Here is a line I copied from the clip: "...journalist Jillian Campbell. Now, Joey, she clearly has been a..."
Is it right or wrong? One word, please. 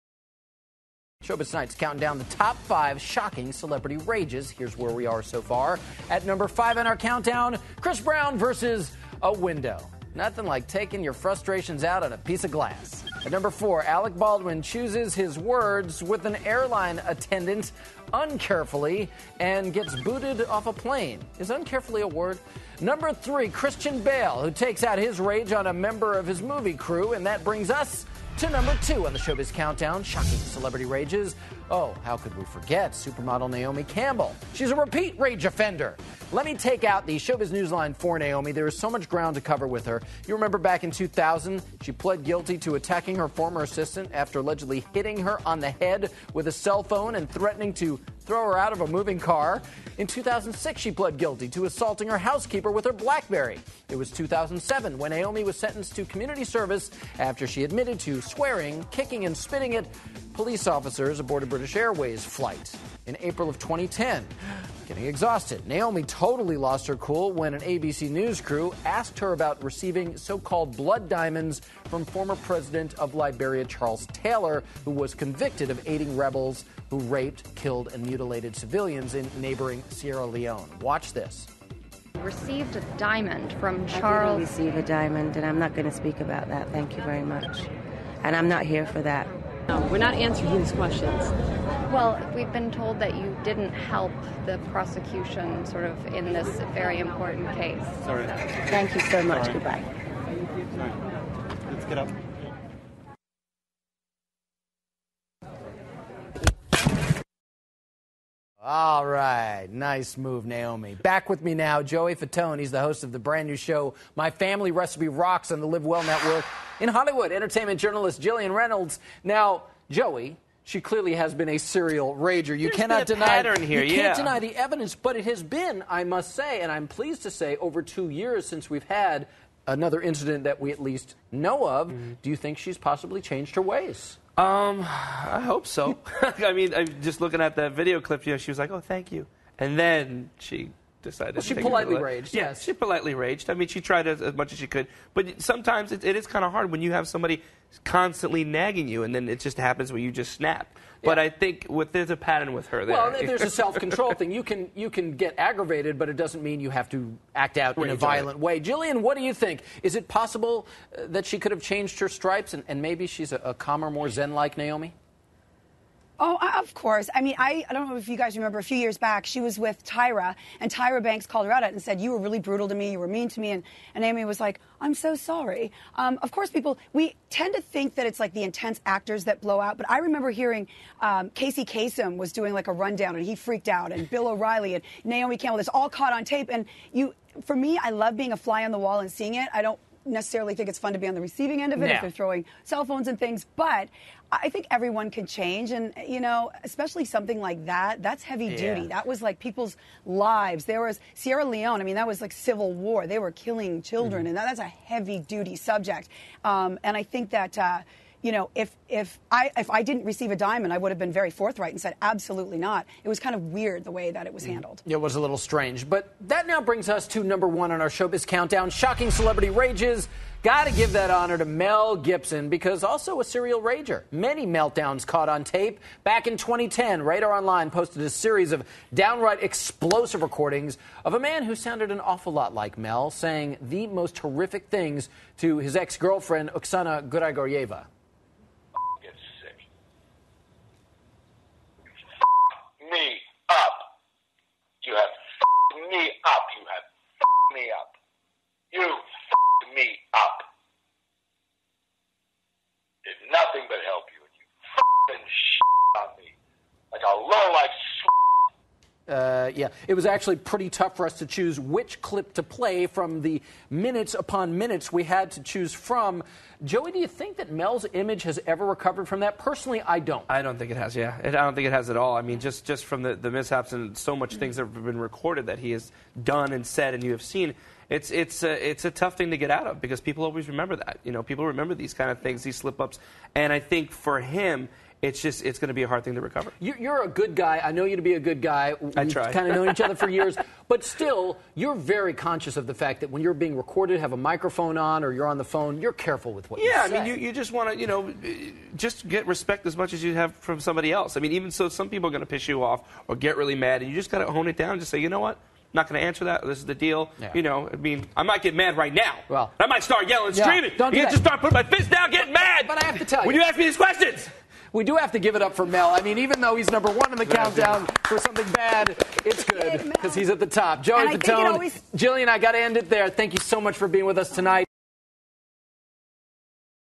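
wrong.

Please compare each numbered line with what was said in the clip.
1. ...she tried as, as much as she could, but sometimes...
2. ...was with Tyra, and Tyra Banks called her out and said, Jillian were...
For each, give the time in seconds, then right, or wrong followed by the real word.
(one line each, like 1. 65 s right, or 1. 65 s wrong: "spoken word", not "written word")
1. 143 s right
2. 169 s wrong: "You", not "Jillian".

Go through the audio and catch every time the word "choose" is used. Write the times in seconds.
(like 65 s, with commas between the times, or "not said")
14 s, 261 s, 265 s.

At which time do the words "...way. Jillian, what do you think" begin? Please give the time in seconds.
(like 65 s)
158 s.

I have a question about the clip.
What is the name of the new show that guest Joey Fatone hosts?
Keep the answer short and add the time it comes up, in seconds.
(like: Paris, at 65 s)
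My Family Recipe Rocks, at 114 s.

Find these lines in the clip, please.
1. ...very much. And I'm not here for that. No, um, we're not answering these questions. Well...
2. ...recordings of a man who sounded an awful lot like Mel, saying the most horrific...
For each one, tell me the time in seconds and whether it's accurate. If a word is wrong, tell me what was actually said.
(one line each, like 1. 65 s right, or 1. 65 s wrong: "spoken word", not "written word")
1. 87 s right
2. 230 s right.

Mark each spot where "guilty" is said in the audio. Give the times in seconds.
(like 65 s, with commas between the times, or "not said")
42 s, 51 s.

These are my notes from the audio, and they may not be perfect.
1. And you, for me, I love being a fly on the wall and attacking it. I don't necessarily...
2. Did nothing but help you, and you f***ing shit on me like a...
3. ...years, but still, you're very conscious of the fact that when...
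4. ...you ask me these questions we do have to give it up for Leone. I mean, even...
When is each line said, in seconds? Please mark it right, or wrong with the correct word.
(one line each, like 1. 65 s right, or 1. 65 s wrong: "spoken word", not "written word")
1. 186 s wrong: "seeing", not "attacking"
2. 253 s right
3. 290 s right
4. 313 s wrong: "Mel", not "Leone".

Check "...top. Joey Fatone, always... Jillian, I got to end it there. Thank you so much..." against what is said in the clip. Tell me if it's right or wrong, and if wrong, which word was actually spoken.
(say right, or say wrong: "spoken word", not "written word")
right.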